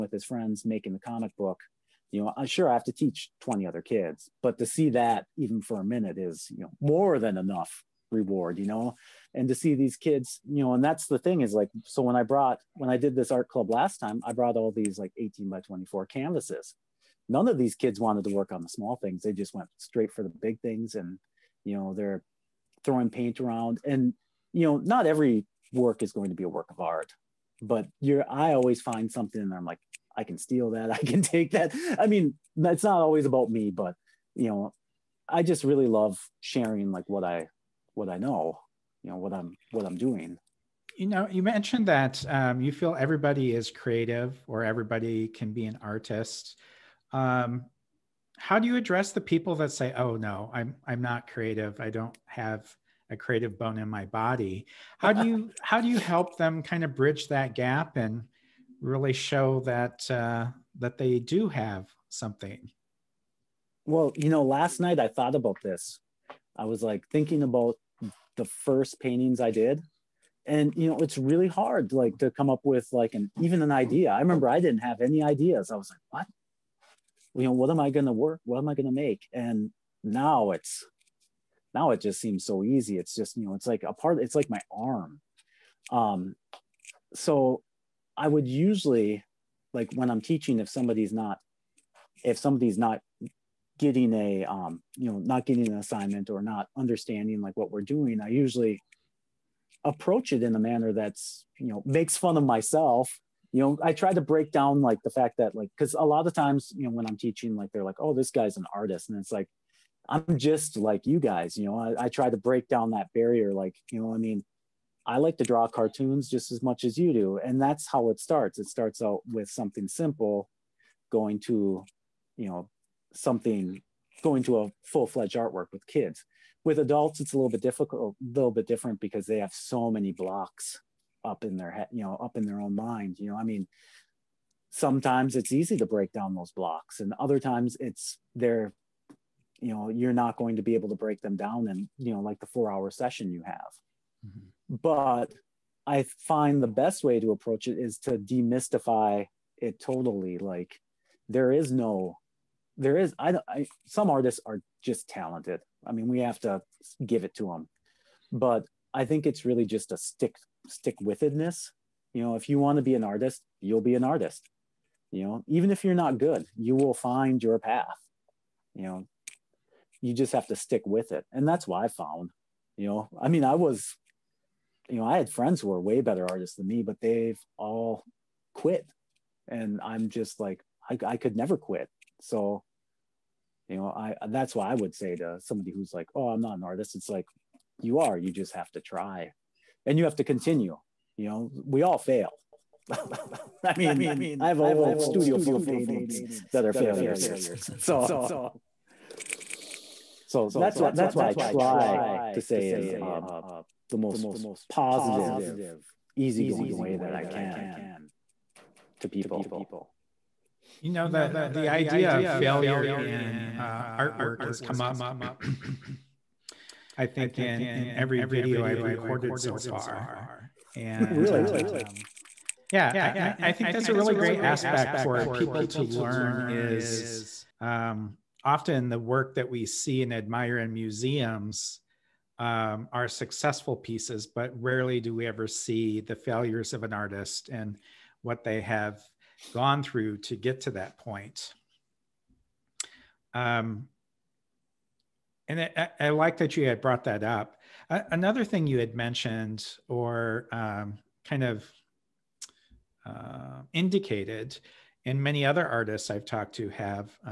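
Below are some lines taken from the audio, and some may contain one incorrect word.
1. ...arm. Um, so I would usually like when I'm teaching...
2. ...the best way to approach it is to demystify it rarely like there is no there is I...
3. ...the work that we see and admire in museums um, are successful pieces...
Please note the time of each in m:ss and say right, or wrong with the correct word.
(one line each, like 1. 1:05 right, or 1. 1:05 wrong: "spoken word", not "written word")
1. 1:24 right
2. 2:26 wrong: "totally", not "rarely"
3. 3:48 right.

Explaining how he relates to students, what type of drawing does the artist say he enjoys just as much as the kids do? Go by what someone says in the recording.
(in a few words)
Cartoons.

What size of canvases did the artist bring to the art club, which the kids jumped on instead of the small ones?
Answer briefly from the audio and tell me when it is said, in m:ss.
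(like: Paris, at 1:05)
18 by 24, at 0:15.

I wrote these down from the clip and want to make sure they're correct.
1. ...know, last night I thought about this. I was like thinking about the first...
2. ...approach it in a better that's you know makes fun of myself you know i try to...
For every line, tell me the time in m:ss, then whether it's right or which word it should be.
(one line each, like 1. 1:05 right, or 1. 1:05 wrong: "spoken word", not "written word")
1. 1:04 right
2. 1:39 wrong: "manner", not "better".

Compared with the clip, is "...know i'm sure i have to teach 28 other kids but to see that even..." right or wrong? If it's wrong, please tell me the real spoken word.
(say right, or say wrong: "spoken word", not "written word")
wrong: "20", not "28".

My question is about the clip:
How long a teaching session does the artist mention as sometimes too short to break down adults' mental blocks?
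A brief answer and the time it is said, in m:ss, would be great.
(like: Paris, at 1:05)
4 hours, at 2:22.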